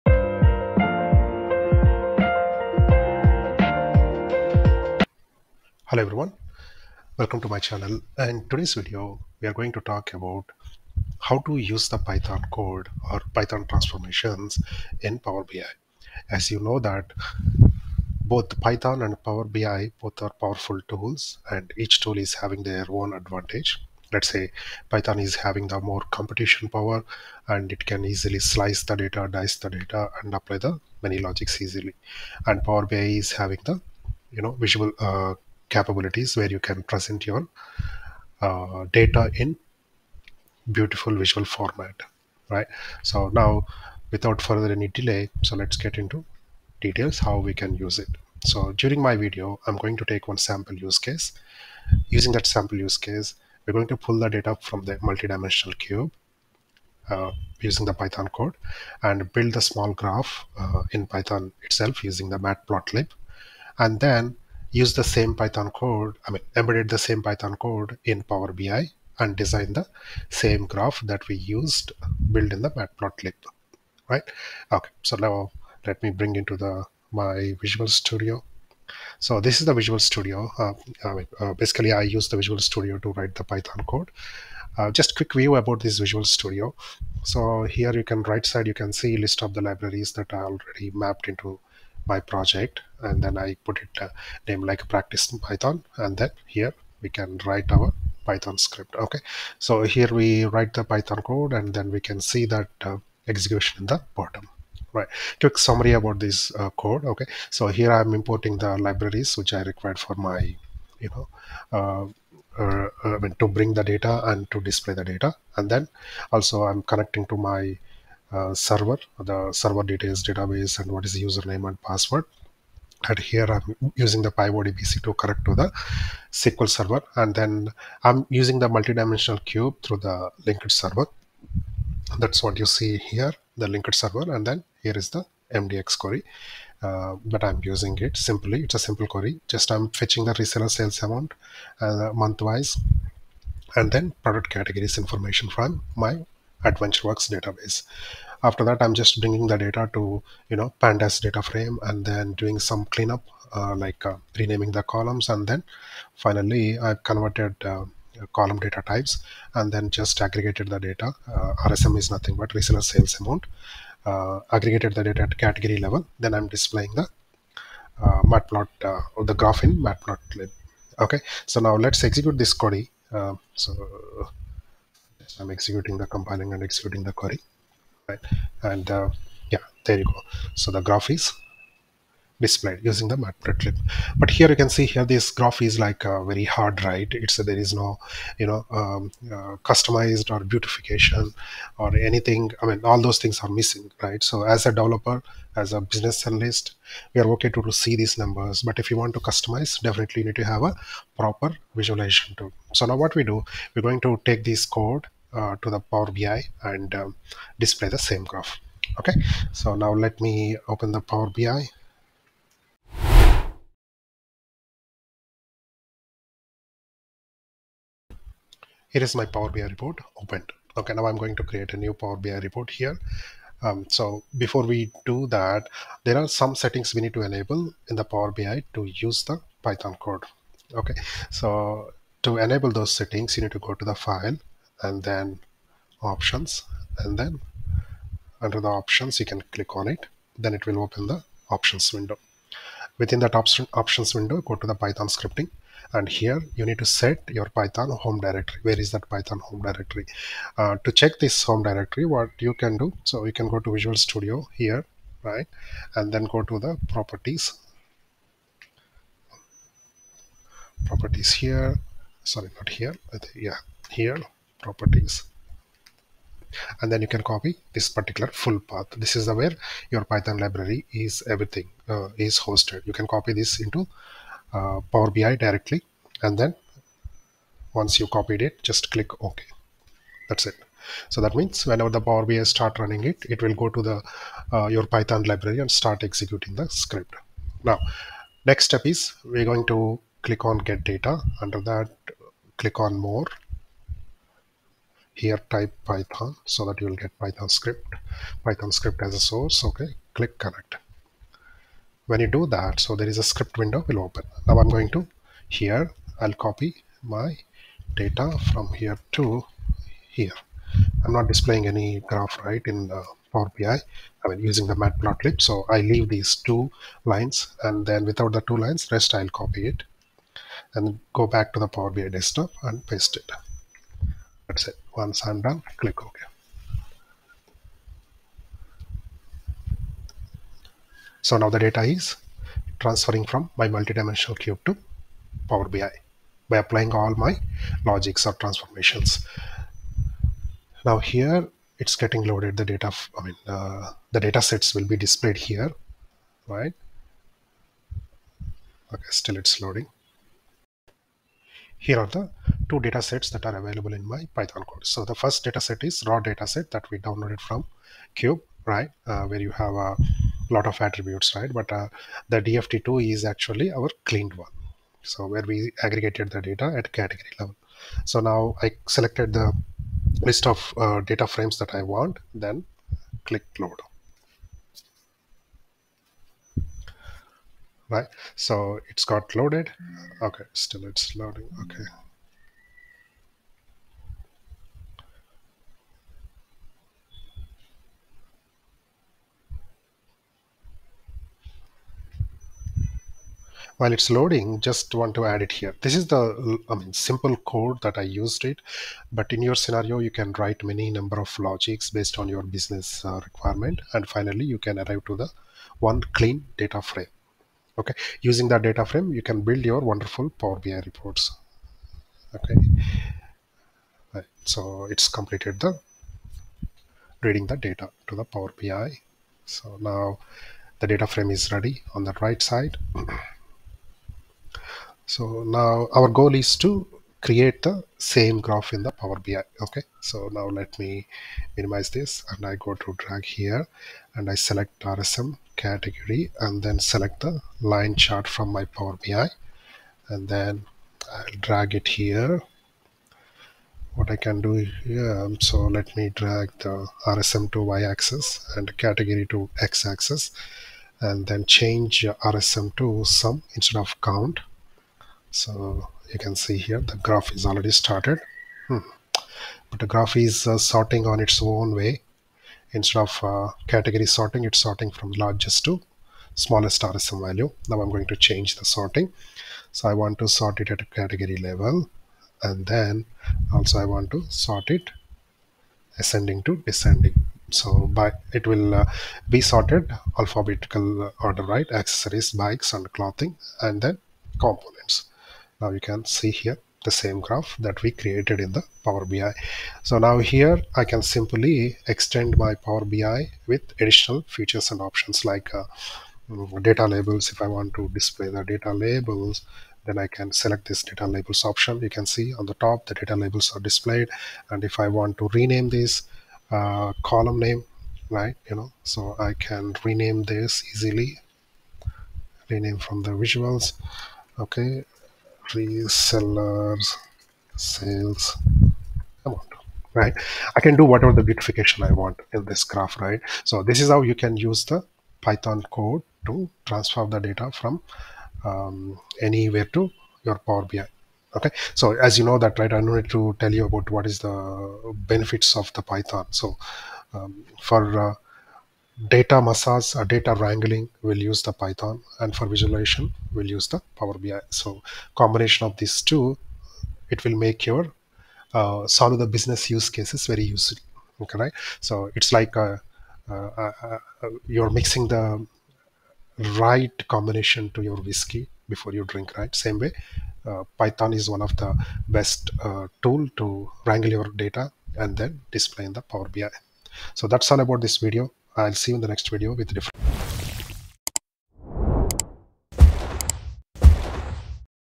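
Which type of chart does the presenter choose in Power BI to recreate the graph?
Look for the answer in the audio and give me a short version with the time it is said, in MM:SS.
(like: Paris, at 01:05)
Line chart, at 07:17.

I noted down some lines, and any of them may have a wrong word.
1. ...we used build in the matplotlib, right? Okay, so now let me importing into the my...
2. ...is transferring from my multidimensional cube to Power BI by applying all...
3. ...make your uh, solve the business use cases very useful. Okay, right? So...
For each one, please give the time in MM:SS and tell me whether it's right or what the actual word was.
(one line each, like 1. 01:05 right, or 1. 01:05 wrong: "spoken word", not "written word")
1. 01:11 wrong: "bring", not "importing"
2. 05:31 right
3. 09:07 right.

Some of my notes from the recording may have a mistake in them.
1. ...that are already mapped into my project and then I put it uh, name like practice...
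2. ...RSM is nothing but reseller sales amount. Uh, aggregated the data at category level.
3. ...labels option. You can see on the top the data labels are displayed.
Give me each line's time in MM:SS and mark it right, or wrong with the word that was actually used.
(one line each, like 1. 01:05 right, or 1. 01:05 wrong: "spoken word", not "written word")
1. 01:30 right
2. 02:41 right
3. 08:21 right.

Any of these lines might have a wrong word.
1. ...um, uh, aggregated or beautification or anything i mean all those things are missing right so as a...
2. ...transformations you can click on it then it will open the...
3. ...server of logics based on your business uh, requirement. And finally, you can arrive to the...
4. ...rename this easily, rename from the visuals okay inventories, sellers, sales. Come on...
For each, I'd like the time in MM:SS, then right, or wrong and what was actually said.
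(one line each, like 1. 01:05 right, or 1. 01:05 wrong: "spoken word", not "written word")
1. 03:08 wrong: "customized", not "aggregated"
2. 03:58 wrong: "options", not "transformations"
3. 06:40 wrong: "number", not "server"
4. 08:29 right.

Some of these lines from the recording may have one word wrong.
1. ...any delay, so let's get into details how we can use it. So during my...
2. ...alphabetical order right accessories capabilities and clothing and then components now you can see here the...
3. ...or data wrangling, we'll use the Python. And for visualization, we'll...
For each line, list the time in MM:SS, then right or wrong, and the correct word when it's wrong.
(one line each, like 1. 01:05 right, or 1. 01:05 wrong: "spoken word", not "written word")
1. 00:44 right
2. 08:00 wrong: "bikes", not "capabilities"
3. 08:59 right.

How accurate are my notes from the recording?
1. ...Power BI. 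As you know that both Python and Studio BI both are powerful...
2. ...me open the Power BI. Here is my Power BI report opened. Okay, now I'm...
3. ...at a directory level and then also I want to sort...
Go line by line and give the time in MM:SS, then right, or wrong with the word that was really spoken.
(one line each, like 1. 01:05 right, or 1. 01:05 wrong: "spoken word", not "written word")
1. 00:15 wrong: "Power", not "Studio"
2. 03:30 right
3. 07:50 wrong: "category", not "directory".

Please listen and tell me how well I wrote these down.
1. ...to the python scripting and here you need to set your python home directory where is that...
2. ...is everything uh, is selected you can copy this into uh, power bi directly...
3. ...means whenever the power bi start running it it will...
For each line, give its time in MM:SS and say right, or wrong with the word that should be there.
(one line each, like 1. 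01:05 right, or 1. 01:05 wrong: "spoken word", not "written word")
1. 04:04 right
2. 04:30 wrong: "hosted", not "selected"
3. 04:41 right.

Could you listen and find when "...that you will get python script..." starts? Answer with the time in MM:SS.
04:56.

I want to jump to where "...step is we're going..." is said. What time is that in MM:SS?
04:48.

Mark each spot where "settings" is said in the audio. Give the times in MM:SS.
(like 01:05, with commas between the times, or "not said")
03:46, 03:52.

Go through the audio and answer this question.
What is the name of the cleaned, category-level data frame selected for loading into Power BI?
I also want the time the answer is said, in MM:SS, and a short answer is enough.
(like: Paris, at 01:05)
DFT2, at 06:02.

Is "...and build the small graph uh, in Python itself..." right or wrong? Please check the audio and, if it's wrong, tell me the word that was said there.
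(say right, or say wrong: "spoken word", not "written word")
right.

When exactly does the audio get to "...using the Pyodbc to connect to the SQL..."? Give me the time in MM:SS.
02:03.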